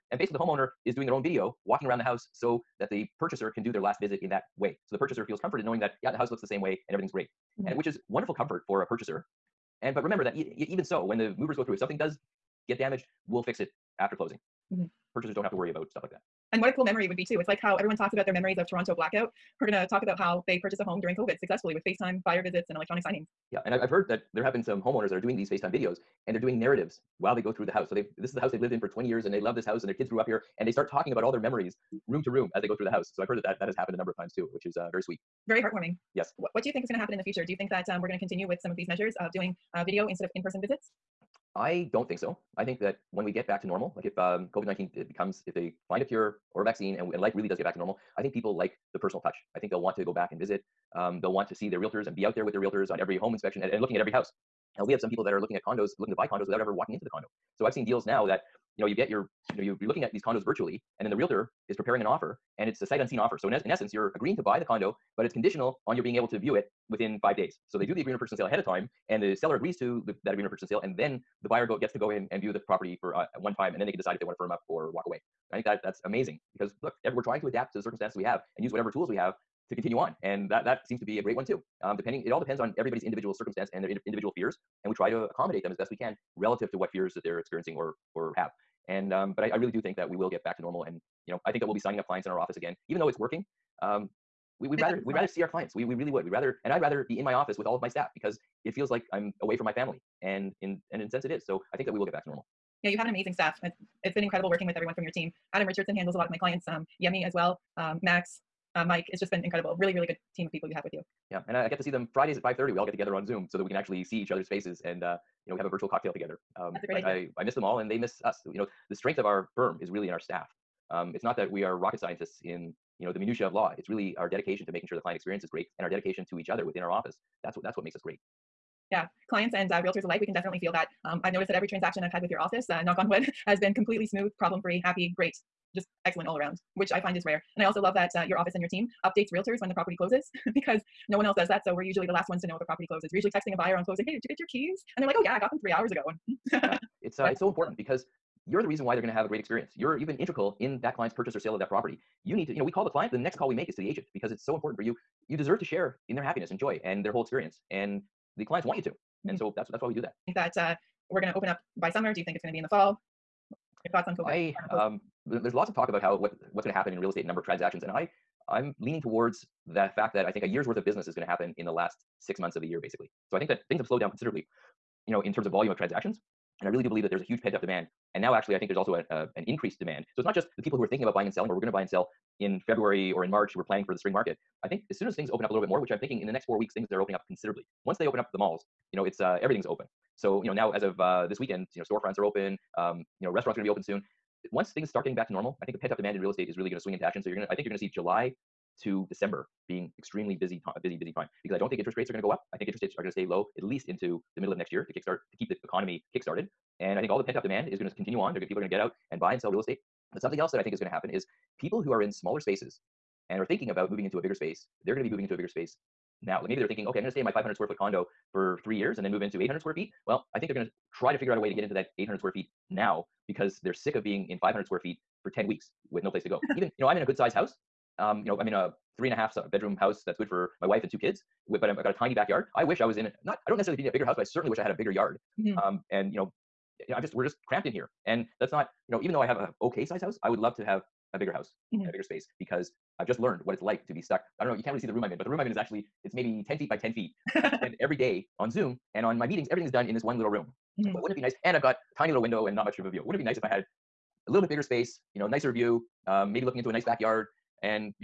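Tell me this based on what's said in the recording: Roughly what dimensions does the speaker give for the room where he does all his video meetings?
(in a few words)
10 feet by 10 feet.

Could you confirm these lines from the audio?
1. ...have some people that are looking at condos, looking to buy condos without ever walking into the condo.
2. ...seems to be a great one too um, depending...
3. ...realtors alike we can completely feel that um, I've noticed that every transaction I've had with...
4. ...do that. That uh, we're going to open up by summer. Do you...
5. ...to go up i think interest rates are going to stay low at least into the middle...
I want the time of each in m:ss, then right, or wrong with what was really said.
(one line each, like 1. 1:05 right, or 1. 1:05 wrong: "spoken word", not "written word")
1. 0:54 right
2. 1:20 right
3. 2:09 wrong: "definitely", not "completely"
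4. 2:39 right
5. 3:22 right.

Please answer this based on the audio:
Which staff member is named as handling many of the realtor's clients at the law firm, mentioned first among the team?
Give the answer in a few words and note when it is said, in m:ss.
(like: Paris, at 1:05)
Adam Richardson, at 1:45.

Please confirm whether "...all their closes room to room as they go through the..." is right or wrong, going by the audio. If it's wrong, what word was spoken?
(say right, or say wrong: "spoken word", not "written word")
wrong: "memories", not "closes".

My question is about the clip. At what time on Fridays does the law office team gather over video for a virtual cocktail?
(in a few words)
5:30.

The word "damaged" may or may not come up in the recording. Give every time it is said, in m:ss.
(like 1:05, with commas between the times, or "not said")
0:12.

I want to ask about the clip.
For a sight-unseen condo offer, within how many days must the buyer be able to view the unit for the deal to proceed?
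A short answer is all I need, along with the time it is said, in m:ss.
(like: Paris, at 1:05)
5 days, at 1:07.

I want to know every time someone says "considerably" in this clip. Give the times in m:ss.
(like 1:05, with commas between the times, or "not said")
2:54, 3:07.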